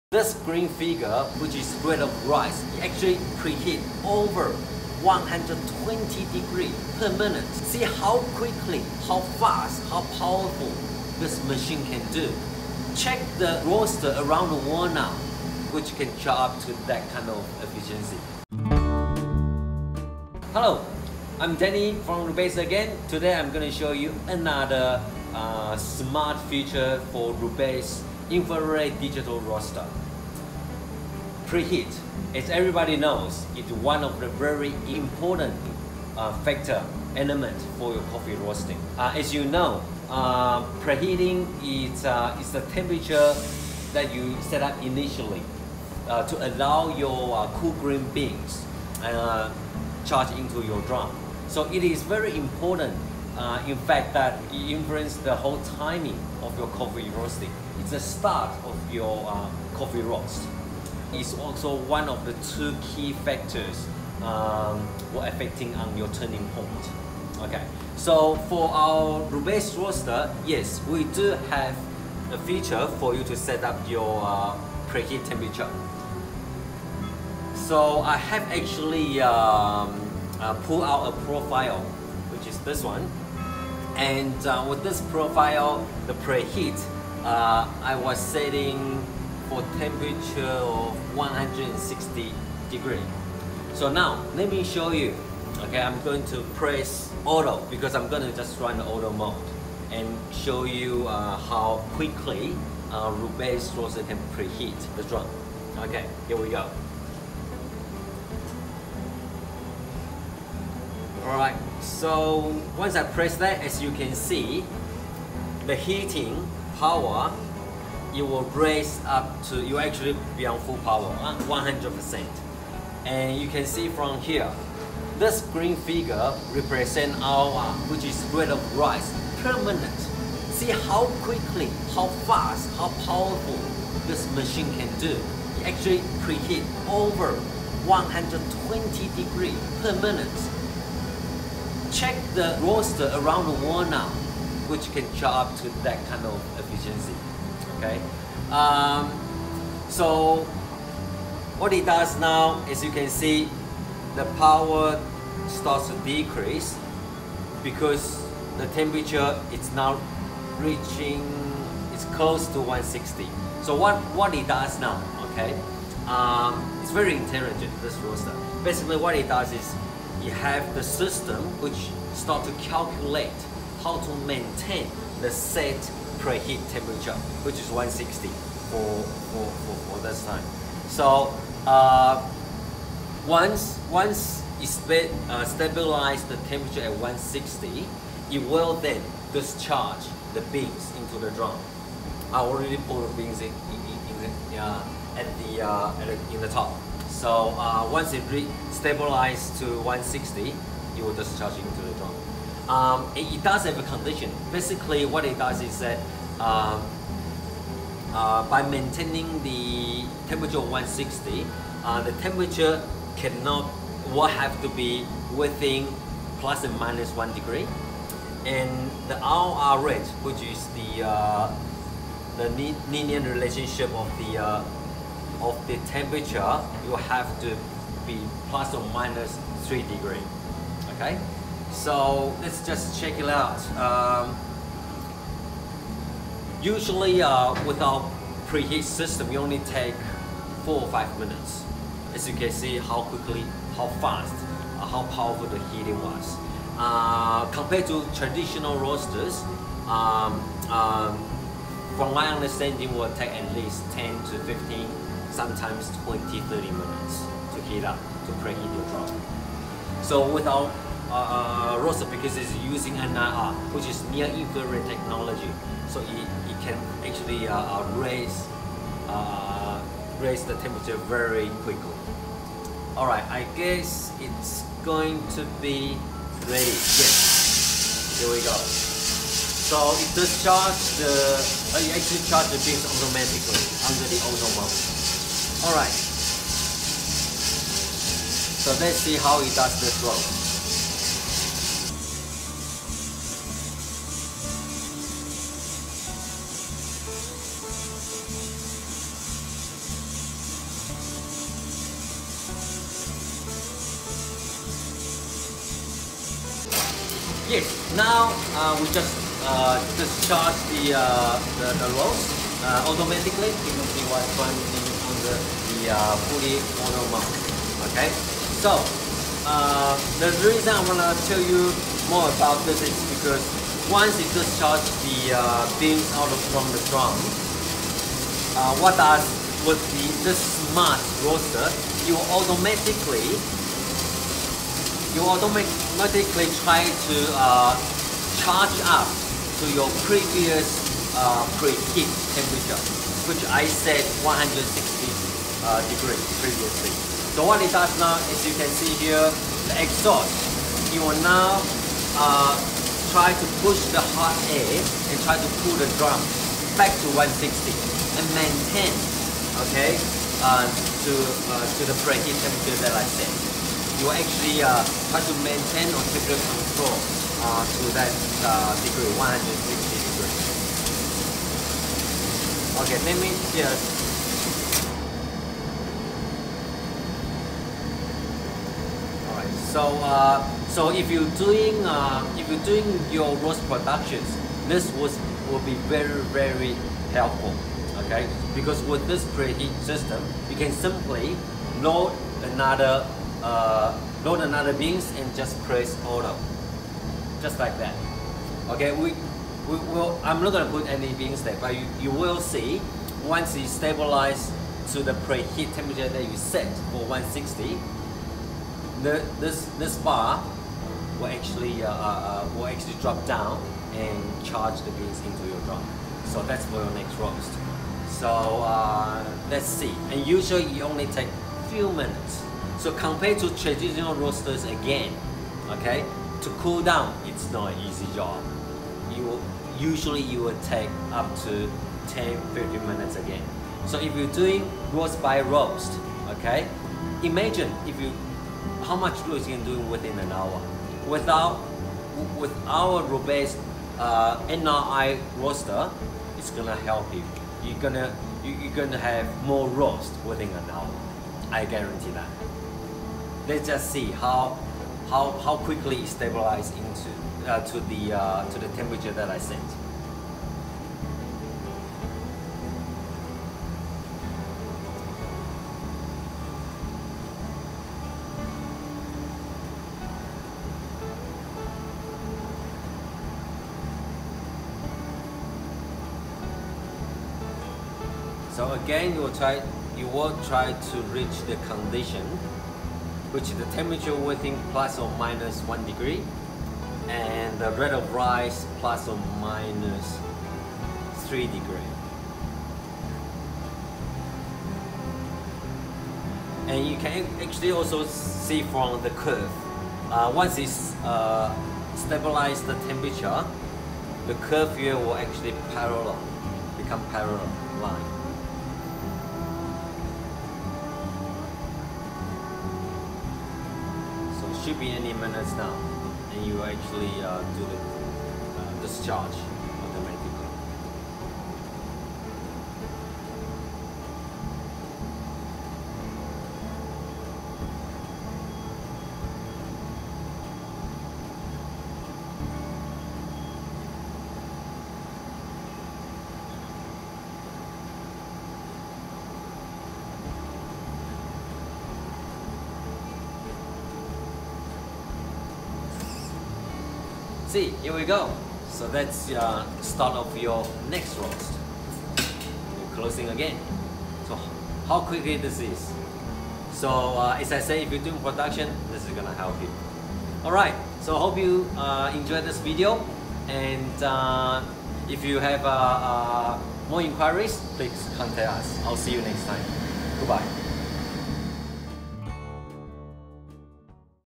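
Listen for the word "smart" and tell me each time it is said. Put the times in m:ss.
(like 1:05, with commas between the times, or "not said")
0:25, 5:30.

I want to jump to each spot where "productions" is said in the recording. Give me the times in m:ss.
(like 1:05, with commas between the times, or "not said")
6:23, 9:18.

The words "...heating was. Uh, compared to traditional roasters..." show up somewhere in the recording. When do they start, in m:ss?
4:05.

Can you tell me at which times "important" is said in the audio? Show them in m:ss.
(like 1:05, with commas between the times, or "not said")
0:34, 0:52.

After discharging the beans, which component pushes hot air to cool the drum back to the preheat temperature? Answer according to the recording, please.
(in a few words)
exhaust.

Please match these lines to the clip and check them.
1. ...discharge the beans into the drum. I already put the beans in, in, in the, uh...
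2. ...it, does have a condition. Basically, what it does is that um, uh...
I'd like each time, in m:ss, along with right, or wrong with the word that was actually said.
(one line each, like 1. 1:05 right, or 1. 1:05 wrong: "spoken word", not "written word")
1. 3:09 right
2. 3:23 right.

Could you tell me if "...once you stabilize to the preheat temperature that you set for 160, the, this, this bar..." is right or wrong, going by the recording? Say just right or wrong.
right.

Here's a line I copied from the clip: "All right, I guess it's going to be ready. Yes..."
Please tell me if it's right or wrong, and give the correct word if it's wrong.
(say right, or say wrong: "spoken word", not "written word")
right.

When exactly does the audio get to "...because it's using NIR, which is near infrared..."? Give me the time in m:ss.
4:22.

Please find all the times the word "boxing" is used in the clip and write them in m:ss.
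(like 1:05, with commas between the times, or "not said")
not said.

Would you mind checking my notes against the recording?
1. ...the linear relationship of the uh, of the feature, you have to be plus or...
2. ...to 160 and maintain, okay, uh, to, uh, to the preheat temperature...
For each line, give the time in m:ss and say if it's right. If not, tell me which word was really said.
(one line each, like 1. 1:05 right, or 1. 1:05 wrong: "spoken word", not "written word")
1. 3:42 wrong: "temperature", not "feature"
2. 5:57 right.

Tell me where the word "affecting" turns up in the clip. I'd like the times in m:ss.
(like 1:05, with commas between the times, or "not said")
1:05.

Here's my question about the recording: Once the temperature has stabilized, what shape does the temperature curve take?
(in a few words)
parallel line.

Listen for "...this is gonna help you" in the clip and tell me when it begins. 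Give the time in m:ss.
9:18.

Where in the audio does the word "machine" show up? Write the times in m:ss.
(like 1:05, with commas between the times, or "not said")
0:11, 2:14.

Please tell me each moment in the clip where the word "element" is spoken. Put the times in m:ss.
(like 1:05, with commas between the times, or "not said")
0:37.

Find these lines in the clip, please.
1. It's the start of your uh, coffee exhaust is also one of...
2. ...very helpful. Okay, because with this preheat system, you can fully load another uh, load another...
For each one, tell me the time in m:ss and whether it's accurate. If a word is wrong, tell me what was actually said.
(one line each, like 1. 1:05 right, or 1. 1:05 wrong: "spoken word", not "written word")
1. 0:57 wrong: "roast", not "exhaust"
2. 6:26 wrong: "simply", not "fully".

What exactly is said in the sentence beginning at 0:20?
Hello, I'm Danny from Rubasse again.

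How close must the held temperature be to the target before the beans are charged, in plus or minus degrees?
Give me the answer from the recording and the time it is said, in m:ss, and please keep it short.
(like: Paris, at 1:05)
1 degree, at 3:36.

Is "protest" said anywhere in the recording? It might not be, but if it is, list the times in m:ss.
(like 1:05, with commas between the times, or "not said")
not said.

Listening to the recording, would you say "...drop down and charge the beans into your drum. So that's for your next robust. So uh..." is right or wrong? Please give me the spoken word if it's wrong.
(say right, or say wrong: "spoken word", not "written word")
wrong: "roast", not "robust".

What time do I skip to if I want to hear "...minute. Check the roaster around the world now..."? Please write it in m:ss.
2:20.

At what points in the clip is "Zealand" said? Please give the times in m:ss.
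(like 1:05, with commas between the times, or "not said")
not said.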